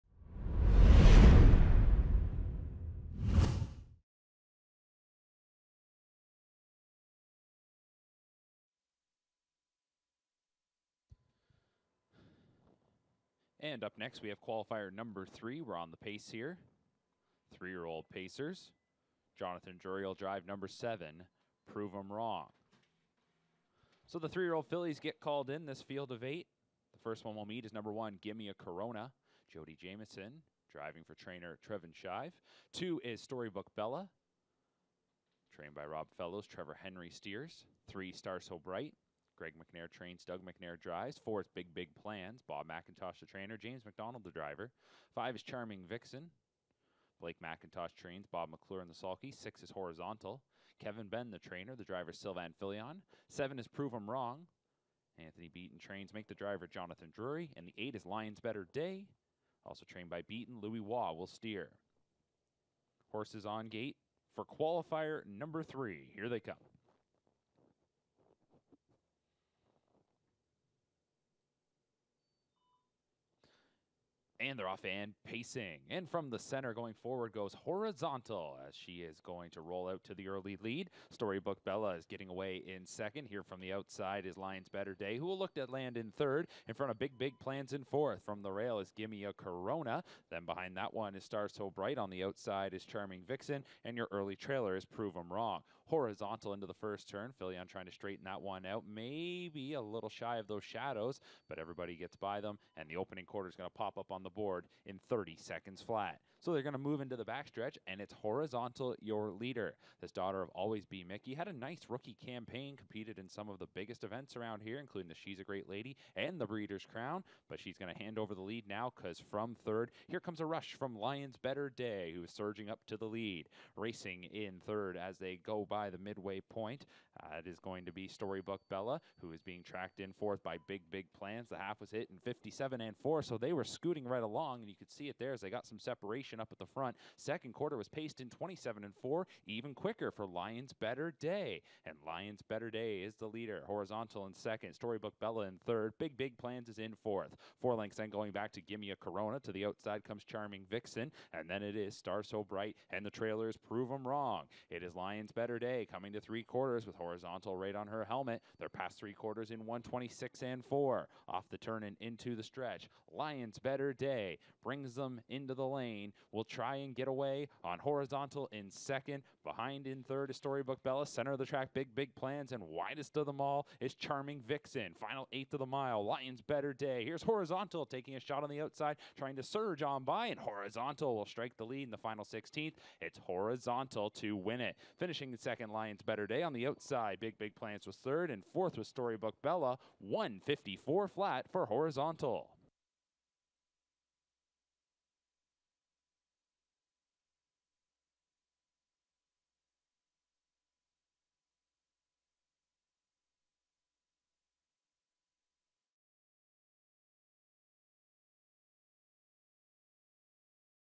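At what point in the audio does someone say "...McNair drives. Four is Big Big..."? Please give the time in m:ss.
0:40.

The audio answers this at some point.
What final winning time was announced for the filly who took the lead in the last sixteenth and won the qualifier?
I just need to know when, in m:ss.
3:09.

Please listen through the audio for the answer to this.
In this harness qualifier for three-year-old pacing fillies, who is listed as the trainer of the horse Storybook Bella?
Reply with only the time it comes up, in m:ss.
0:35.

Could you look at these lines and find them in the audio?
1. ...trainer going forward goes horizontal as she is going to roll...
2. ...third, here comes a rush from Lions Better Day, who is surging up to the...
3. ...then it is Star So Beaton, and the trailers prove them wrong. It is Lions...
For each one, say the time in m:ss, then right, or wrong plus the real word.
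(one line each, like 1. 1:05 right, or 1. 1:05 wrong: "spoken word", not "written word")
1. 1:16 wrong: "center", not "trainer"
2. 1:59 right
3. 2:31 wrong: "Bright", not "Beaton".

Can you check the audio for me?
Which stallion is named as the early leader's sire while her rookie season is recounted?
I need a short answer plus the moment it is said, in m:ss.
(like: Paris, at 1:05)
Always B Miki, at 1:50.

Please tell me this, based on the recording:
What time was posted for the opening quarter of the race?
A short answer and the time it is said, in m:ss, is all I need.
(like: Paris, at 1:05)
30 seconds flat, at 1:45.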